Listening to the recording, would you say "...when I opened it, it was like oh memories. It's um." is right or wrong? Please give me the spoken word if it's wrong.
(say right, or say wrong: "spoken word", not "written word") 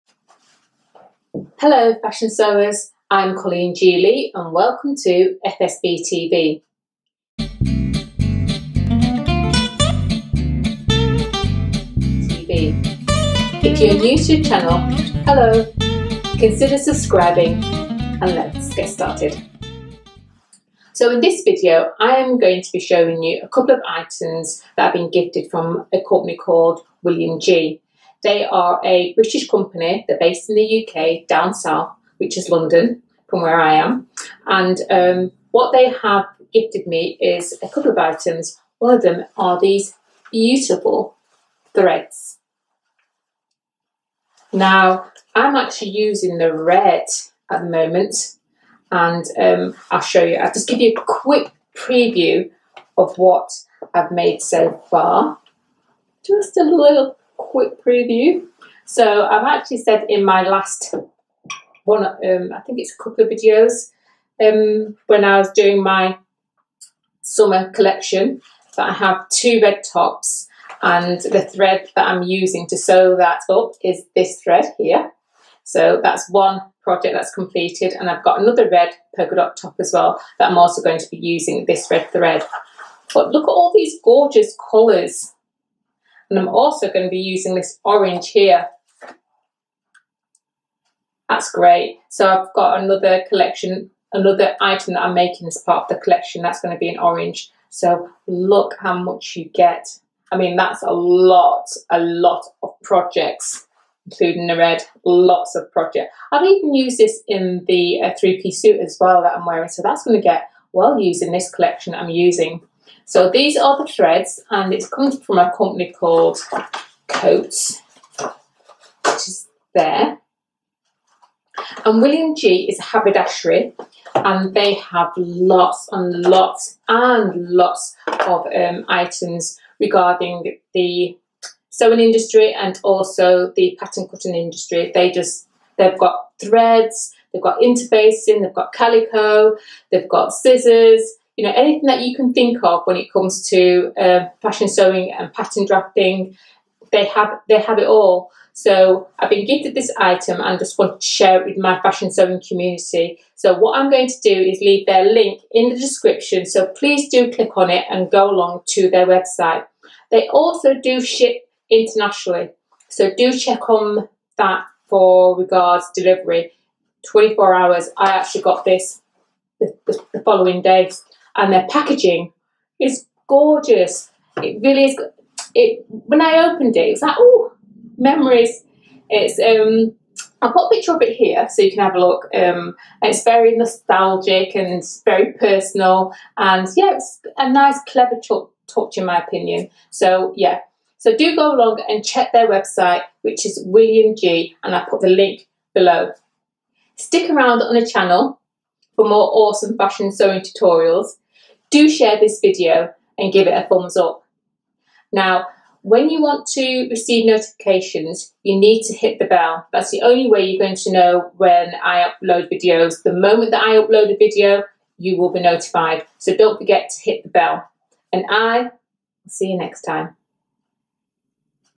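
right.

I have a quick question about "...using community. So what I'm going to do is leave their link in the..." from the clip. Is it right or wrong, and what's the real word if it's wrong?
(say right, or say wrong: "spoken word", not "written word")
wrong: "sewing", not "using".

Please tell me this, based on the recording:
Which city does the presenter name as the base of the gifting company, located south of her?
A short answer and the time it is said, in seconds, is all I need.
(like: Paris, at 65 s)
London, at 32 s.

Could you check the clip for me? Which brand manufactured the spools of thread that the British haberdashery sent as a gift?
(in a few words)
Coats.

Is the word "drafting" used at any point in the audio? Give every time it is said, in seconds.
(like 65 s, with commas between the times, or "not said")
145 s.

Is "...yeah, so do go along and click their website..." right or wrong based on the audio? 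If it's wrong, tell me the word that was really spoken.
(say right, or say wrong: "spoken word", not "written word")
wrong: "check", not "click".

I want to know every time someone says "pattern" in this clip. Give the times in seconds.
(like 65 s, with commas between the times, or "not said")
133 s, 145 s.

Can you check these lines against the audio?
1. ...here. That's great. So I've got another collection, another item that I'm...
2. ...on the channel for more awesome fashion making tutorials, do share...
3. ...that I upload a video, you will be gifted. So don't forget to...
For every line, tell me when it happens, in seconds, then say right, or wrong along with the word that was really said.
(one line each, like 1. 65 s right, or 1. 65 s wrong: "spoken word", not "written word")
1. 88 s right
2. 197 s wrong: "sewing", not "making"
3. 213 s wrong: "notified", not "gifted".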